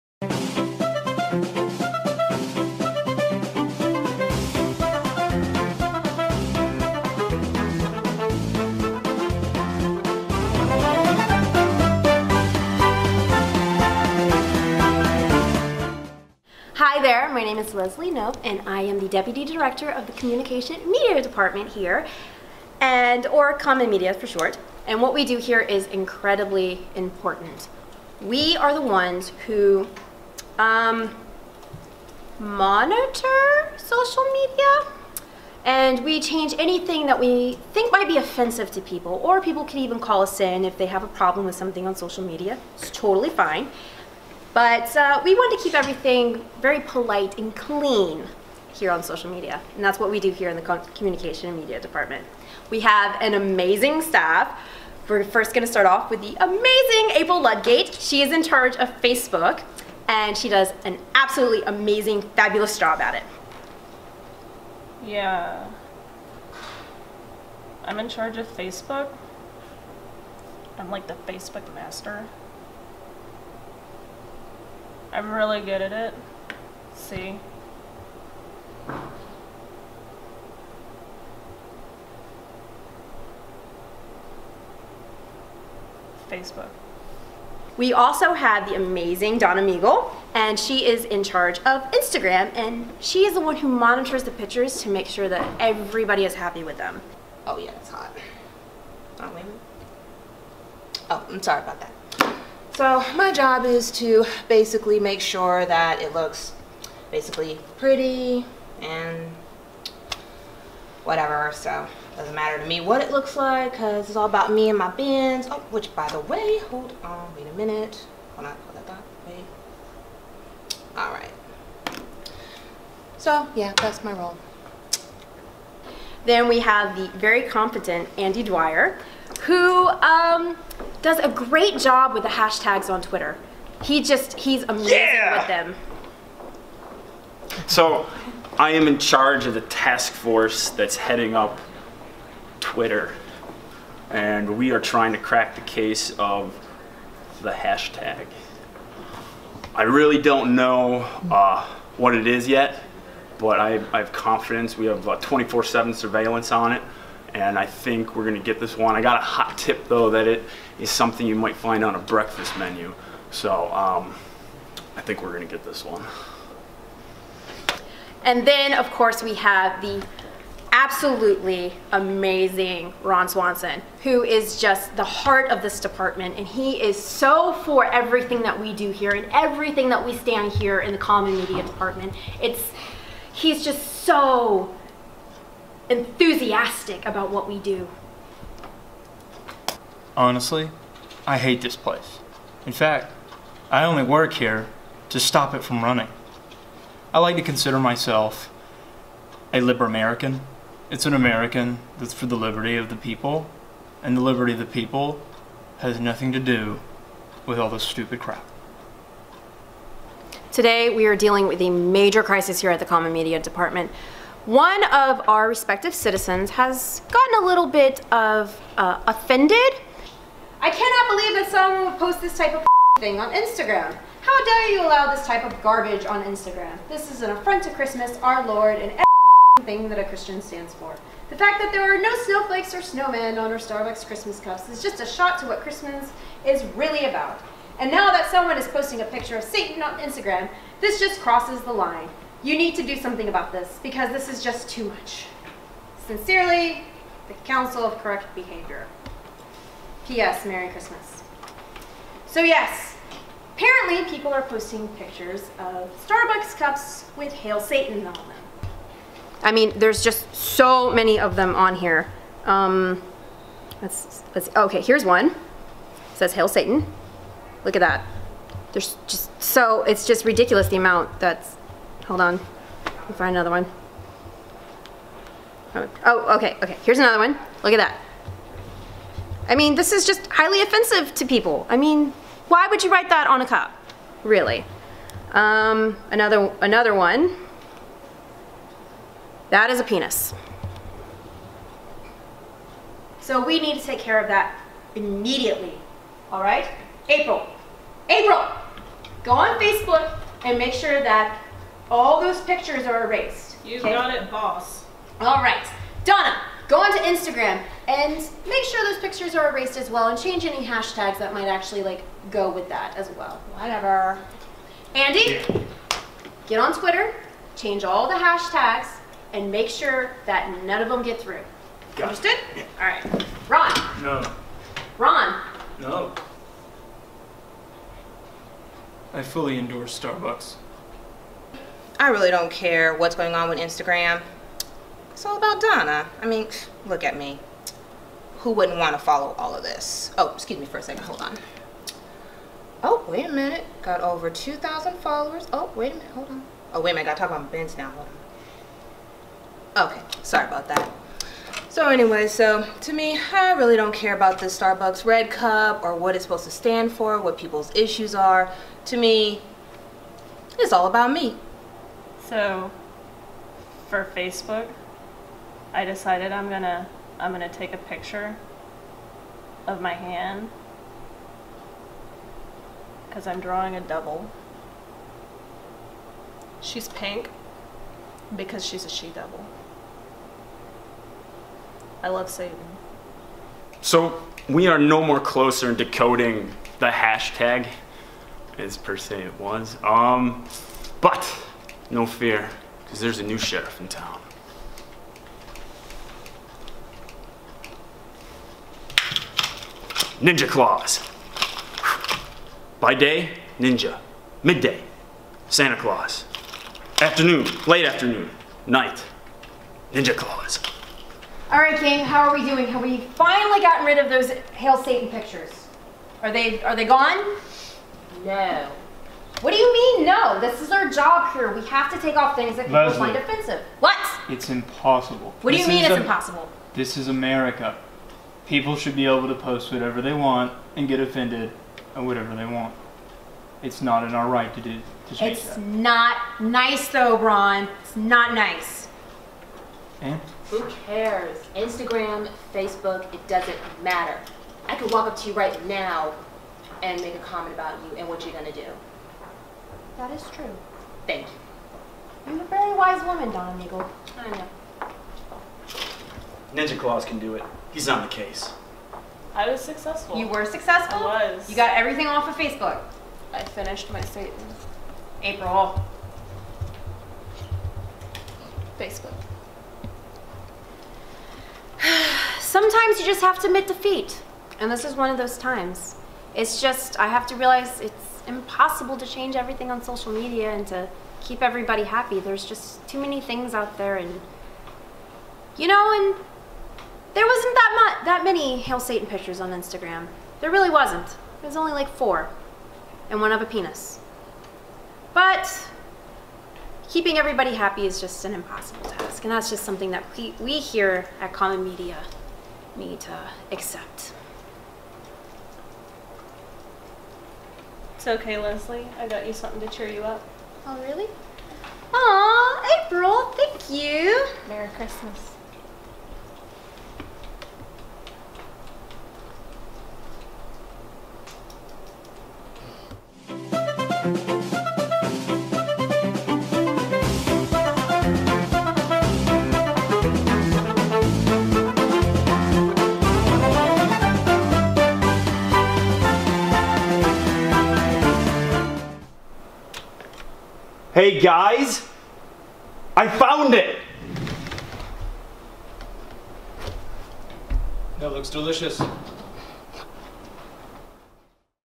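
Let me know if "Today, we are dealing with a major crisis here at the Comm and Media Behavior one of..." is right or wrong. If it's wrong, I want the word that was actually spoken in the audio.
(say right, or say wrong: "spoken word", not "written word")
wrong: "Department", not "Behavior".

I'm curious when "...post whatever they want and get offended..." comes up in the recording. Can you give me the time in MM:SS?
07:09.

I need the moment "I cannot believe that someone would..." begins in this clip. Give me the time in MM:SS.
03:40.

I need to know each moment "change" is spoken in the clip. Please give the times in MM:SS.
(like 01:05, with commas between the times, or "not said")
00:36, 05:10, 05:17, 07:15, 07:59.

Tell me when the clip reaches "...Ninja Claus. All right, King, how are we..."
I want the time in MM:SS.
06:49.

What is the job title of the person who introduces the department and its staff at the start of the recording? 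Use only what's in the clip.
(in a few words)
Deputy Director.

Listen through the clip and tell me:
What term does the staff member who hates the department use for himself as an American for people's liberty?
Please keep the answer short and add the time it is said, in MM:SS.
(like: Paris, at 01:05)
liber American, at 03:19.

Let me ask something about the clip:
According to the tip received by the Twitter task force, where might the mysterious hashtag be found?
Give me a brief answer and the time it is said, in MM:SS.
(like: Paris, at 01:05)
a breakfast menu, at 02:41.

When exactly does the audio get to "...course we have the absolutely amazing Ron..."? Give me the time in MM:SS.
02:48.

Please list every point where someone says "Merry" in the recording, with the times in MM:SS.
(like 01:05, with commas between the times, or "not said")
04:10, 08:34.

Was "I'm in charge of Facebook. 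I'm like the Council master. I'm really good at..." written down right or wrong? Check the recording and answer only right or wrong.
wrong.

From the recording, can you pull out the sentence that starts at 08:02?
There's just too many things out there and you know and there wasn't that much that many Hail Satan pictures on Instagram.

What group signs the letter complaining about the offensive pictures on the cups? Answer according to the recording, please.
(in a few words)
Council of Correct Behavior.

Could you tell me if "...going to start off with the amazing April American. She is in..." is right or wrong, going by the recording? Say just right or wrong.
wrong.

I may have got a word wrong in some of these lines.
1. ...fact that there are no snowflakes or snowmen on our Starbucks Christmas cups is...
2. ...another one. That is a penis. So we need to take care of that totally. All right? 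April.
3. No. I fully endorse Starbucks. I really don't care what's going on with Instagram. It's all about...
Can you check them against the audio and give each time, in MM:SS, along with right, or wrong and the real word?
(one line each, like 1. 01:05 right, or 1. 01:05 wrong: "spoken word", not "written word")
1. 03:51 right
2. 04:46 wrong: "immediately", not "totally"
3. 05:25 right.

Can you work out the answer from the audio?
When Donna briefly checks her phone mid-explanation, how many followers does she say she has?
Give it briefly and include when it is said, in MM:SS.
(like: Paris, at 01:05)
Over 2,000, at 05:44.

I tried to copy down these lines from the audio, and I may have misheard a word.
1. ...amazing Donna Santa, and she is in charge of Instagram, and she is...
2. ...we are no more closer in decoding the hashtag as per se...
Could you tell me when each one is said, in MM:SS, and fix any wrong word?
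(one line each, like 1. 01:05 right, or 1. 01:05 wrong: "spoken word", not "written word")
1. 01:28 wrong: "Meagle", not "Santa"
2. 06:24 right.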